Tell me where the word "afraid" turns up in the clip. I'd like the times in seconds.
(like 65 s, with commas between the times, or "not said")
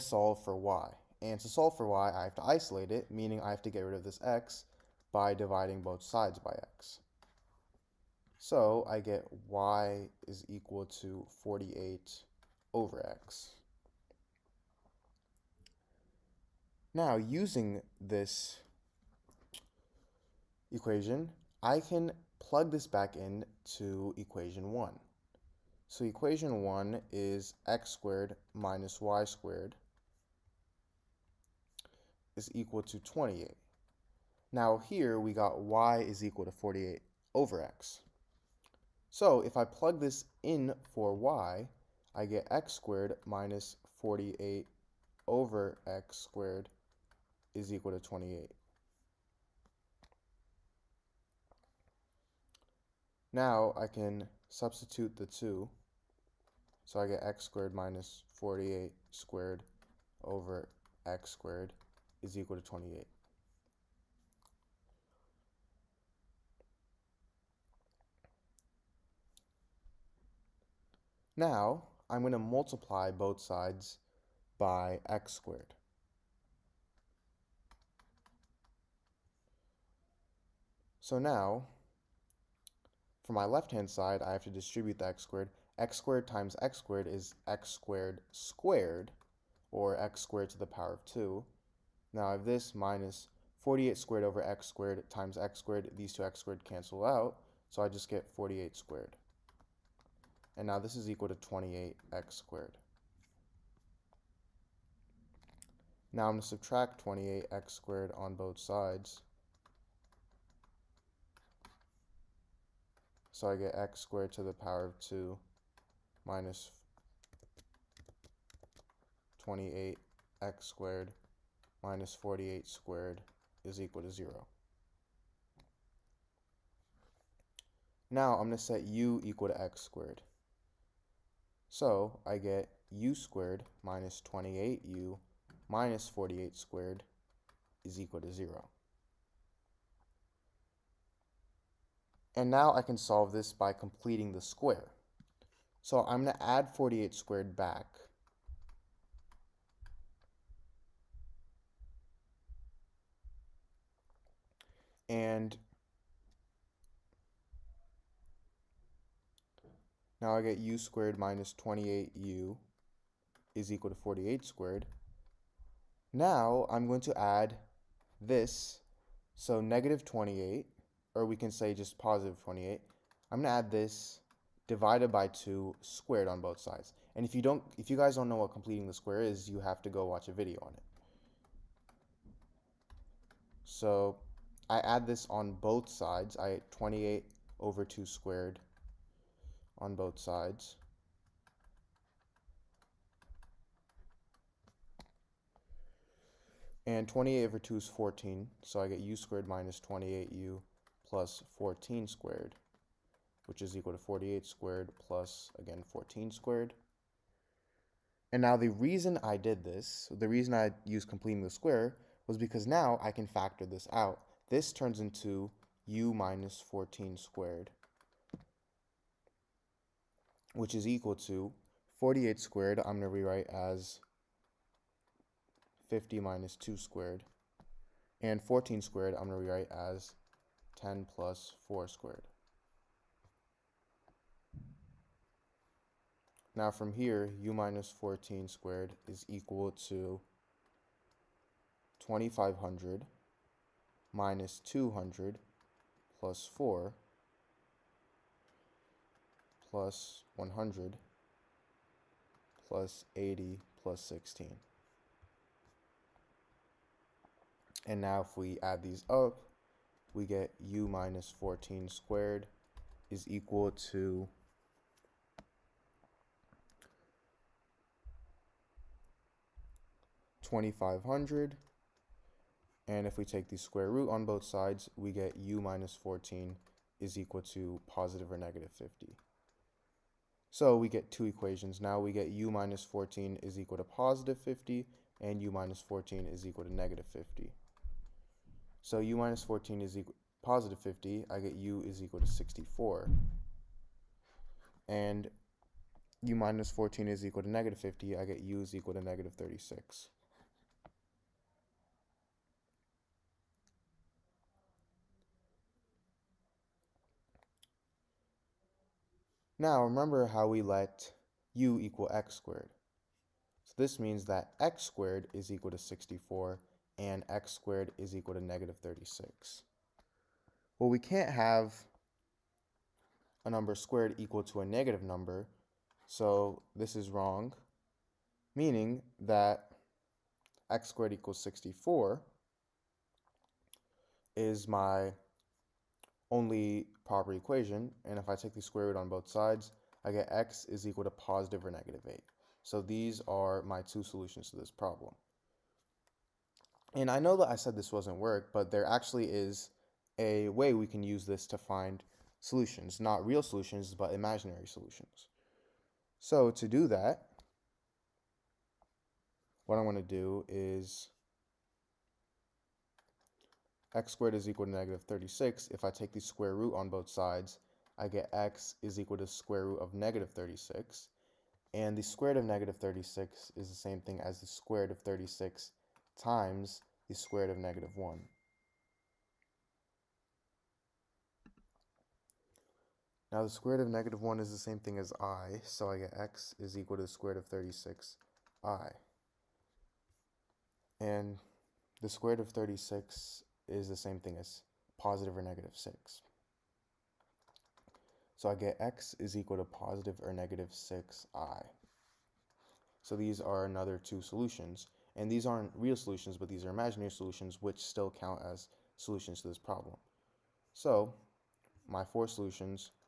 not said.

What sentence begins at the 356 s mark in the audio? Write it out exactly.
So to do that, what I'm going to do is x squared is equal to negative 36.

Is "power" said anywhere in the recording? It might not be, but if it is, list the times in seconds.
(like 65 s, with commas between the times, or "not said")
90 s, 114 s.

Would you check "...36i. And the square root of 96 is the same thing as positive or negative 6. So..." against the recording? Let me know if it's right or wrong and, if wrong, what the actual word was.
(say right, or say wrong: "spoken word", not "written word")
wrong: "36", not "96".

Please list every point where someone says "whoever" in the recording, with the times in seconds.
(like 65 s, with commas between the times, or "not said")
not said.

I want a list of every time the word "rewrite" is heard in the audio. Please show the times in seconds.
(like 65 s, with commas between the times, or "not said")
223 s, 229 s.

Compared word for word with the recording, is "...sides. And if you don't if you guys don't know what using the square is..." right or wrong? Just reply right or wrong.
wrong.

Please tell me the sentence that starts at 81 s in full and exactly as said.
So now, for my left-hand side, I have to distribute the x squared.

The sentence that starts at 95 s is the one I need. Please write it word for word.
These two x squared cancel out, so I just get 48 squared.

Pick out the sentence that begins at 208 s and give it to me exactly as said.
And now the reason I did this, the reason I used completing the square, was because now I can factor this out.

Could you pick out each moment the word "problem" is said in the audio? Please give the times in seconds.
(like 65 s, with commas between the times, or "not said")
344 s, 409 s.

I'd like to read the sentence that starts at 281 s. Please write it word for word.
Now we get u minus 14 is equal to positive 50 and u minus 14 is equal to negative 50.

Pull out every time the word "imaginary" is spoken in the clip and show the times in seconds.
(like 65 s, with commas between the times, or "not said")
354 s, 406 s.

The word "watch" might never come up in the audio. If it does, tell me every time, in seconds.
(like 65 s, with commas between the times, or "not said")
180 s.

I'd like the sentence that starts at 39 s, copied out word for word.
So if I plug this in for y, I get x squared minus 48 over x squared is equal to 28.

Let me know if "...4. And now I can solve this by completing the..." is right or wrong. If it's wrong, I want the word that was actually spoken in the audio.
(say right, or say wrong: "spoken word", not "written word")
wrong: "0", not "4".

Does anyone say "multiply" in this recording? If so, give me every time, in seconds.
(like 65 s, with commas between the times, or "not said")
72 s.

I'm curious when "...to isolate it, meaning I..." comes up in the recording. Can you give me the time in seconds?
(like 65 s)
2 s.